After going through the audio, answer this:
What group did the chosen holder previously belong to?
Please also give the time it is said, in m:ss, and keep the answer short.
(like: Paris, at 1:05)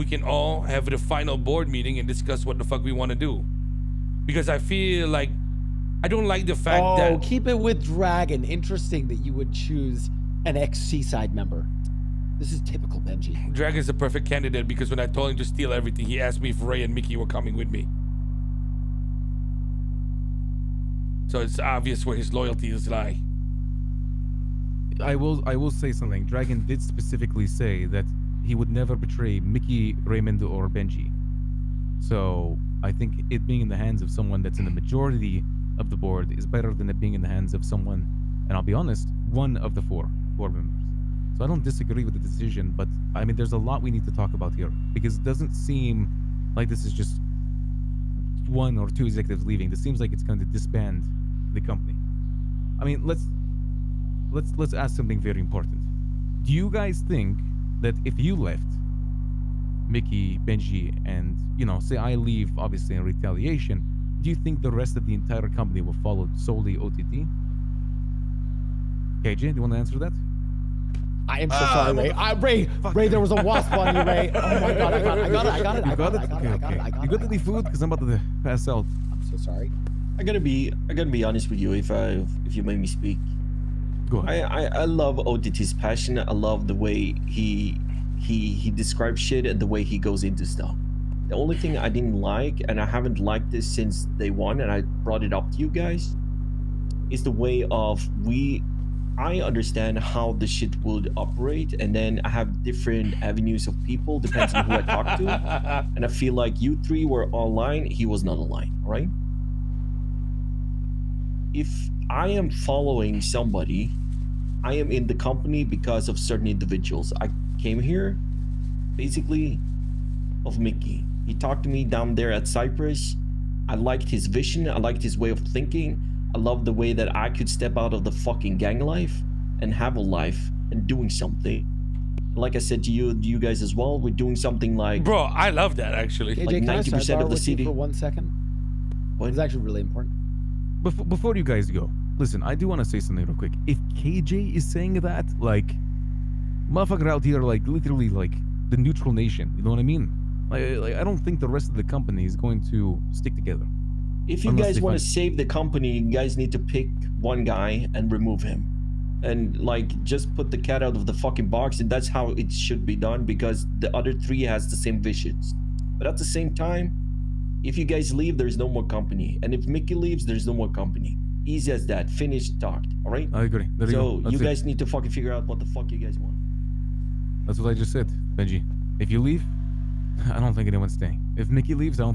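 Seaside, at 0:10.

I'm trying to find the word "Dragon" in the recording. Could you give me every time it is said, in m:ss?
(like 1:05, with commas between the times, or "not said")
0:07, 0:13, 0:26.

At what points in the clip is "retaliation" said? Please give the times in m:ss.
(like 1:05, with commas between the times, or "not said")
1:03.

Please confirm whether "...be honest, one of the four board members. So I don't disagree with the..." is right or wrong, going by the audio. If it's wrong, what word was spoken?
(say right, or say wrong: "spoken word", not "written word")
right.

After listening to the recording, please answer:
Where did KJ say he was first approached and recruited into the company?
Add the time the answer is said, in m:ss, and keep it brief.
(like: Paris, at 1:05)
Cypress, at 2:02.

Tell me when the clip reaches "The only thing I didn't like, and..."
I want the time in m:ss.
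1:31.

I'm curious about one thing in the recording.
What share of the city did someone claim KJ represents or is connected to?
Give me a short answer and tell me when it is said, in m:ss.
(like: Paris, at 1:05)
90%, at 2:16.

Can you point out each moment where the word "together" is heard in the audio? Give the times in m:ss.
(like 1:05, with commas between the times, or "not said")
2:33.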